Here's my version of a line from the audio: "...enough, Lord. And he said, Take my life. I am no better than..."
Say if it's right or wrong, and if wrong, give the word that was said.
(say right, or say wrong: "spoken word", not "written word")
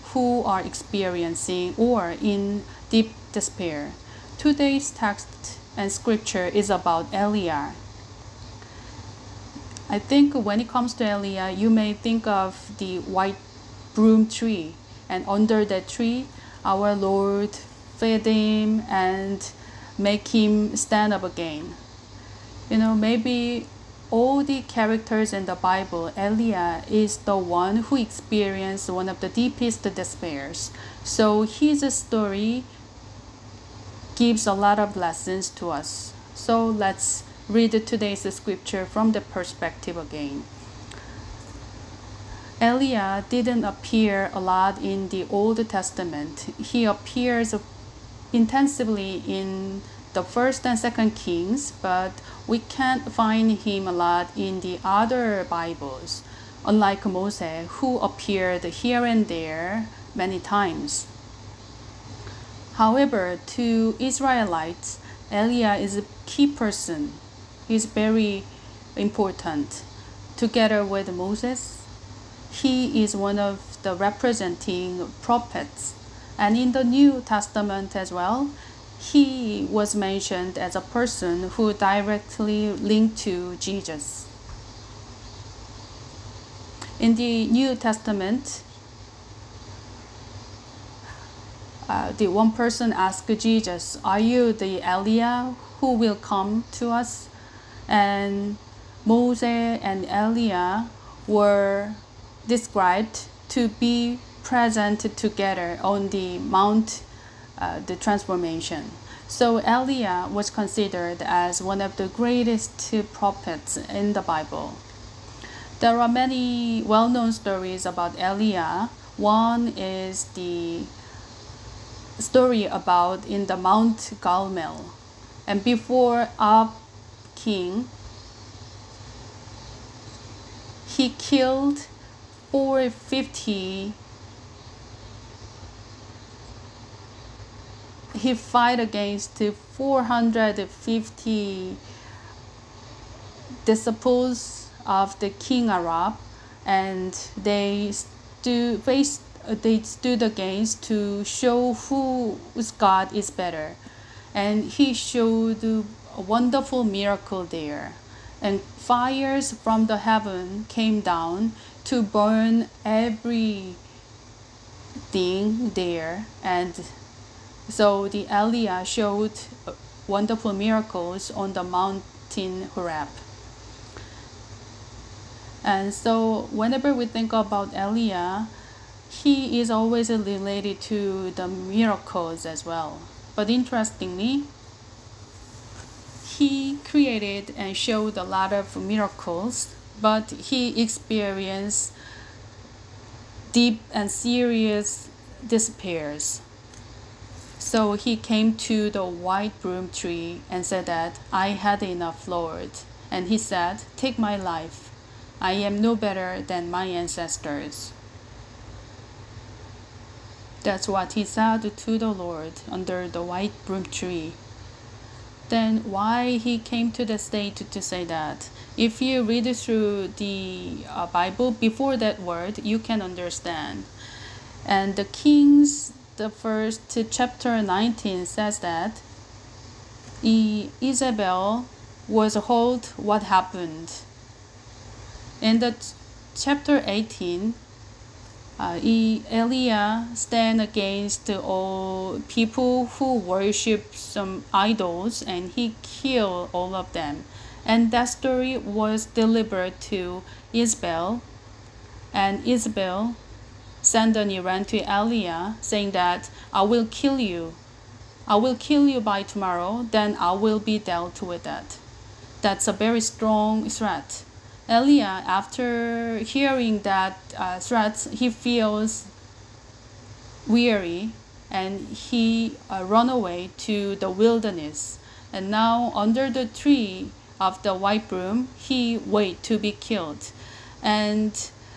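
right.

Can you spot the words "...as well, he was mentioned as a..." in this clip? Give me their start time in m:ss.
1:17.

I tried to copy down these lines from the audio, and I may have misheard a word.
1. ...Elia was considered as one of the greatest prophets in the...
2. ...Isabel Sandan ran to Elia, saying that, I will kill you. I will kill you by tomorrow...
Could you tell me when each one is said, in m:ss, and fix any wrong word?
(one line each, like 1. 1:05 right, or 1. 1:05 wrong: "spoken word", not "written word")
1. 1:49 right
2. 4:12 right.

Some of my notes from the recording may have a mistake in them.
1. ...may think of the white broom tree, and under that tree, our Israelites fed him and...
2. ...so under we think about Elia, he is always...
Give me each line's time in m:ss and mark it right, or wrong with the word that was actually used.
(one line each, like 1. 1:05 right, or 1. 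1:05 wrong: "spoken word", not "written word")
1. 0:11 wrong: "Lord", not "Israelites"
2. 2:55 wrong: "whenever", not "under".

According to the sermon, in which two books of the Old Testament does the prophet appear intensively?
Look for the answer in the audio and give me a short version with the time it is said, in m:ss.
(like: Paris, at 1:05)
First and Second Kings, at 0:50.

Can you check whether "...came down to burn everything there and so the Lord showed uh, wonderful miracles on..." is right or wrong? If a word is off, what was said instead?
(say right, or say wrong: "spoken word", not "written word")
wrong: "Elia", not "Lord".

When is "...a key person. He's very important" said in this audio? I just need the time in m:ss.
1:05.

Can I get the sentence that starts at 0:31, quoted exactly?
So his story gives a lot of lessons to us.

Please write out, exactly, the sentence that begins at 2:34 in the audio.
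And he showed a wonderful miracle there.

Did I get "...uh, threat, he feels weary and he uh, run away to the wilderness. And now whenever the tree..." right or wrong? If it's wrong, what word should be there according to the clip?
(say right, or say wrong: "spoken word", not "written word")
wrong: "under", not "whenever".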